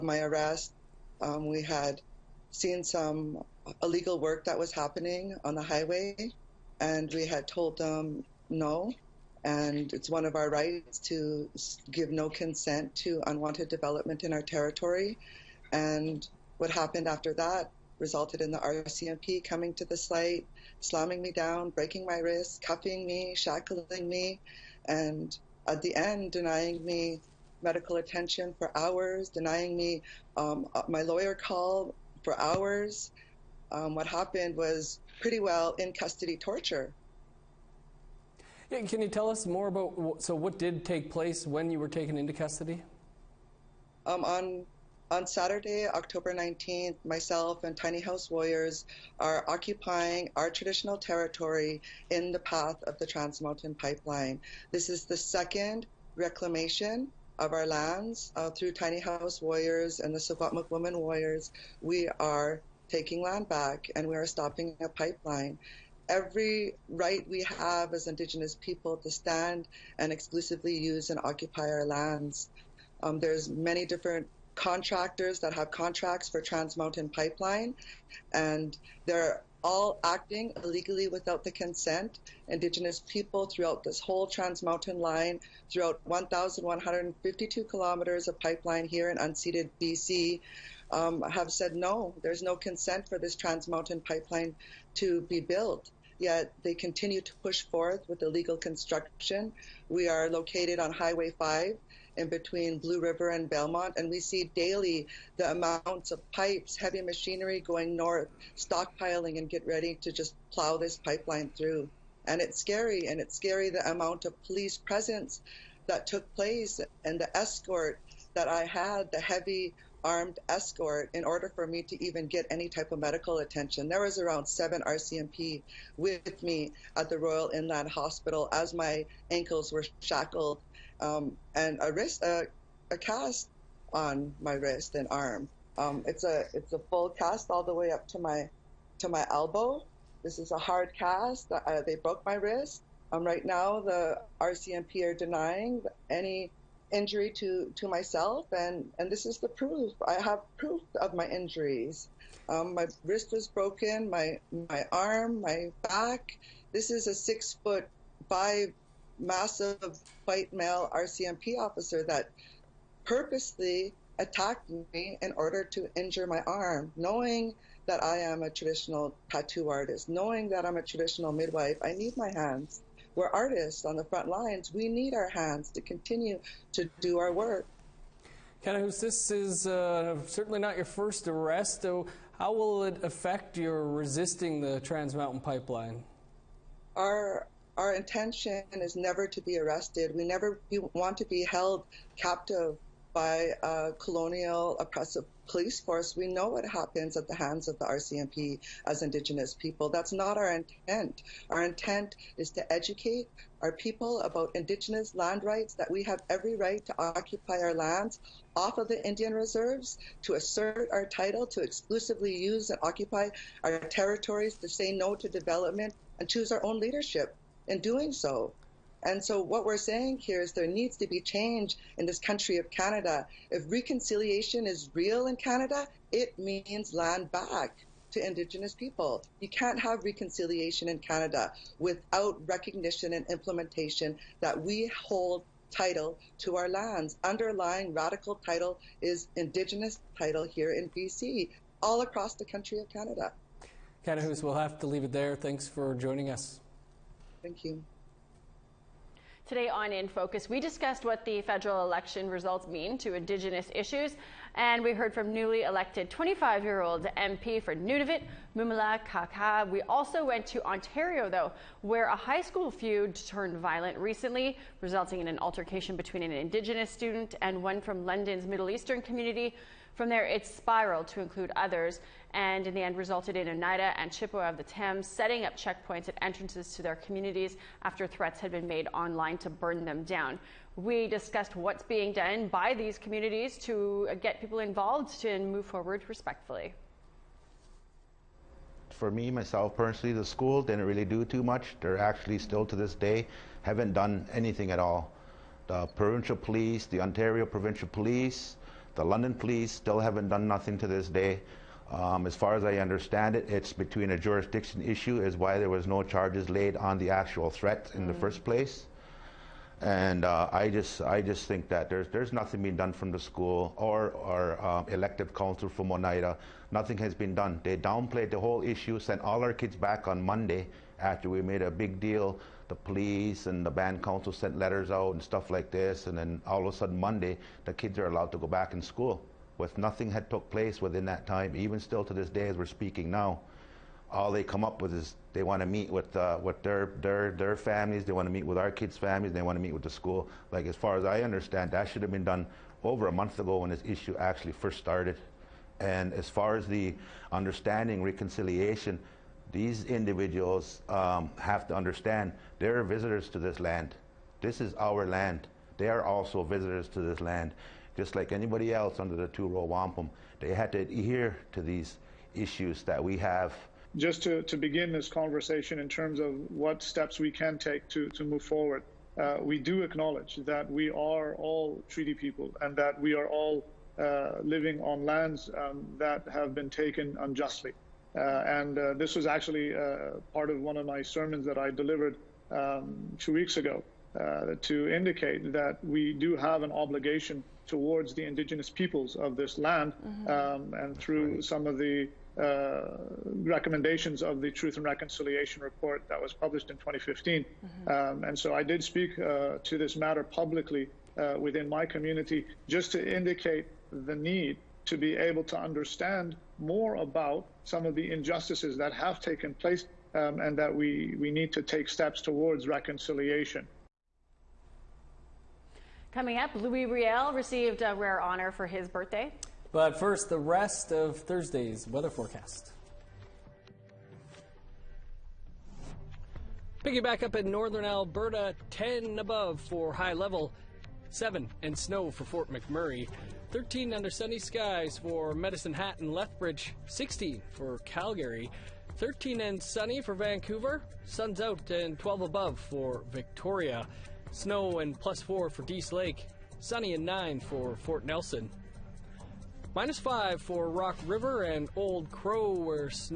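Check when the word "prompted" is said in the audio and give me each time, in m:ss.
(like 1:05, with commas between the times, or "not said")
not said.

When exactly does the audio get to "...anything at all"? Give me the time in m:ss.
4:54.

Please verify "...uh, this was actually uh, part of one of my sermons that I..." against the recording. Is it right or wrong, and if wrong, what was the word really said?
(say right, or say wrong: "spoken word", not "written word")
right.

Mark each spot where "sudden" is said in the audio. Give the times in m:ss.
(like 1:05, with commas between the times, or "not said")
5:26.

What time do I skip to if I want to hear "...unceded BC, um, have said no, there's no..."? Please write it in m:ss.
1:29.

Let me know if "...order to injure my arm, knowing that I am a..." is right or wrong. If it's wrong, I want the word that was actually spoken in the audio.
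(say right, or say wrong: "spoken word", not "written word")
right.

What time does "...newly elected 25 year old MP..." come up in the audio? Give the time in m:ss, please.
4:15.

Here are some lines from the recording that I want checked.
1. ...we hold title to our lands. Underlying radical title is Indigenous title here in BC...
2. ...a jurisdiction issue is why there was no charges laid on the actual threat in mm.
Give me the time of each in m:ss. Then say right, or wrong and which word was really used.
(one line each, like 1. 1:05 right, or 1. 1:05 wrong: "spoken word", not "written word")
1. 3:54 right
2. 5:04 right.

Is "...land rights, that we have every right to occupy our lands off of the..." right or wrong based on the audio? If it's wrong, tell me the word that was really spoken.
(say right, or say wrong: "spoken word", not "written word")
right.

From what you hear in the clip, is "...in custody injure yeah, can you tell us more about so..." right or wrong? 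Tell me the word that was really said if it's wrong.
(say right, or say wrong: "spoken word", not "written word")
wrong: "torture", not "injure".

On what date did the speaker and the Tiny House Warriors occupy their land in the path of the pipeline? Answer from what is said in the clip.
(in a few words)
October 19.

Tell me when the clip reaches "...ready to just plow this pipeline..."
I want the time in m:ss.
1:49.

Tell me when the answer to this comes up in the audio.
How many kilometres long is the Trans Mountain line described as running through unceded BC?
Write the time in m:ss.
1:26.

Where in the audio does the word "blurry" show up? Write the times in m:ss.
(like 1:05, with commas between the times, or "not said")
not said.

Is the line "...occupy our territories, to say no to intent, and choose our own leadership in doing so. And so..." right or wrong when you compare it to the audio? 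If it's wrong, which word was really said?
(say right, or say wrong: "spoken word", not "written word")
wrong: "development", not "intent".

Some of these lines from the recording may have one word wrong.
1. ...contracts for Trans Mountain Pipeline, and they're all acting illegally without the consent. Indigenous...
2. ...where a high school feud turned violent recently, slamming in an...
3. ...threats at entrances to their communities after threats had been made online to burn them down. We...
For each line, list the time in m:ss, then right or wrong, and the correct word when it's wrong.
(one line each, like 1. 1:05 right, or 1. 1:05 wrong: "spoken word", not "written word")
1. 1:15 right
2. 4:21 wrong: "resulting", not "slamming"
3. 4:35 wrong: "checkpoints", not "threats".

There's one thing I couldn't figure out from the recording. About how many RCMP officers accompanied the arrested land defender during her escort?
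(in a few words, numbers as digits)
7.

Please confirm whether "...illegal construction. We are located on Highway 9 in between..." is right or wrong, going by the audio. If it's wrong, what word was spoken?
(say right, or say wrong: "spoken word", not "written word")
wrong: "5", not "9".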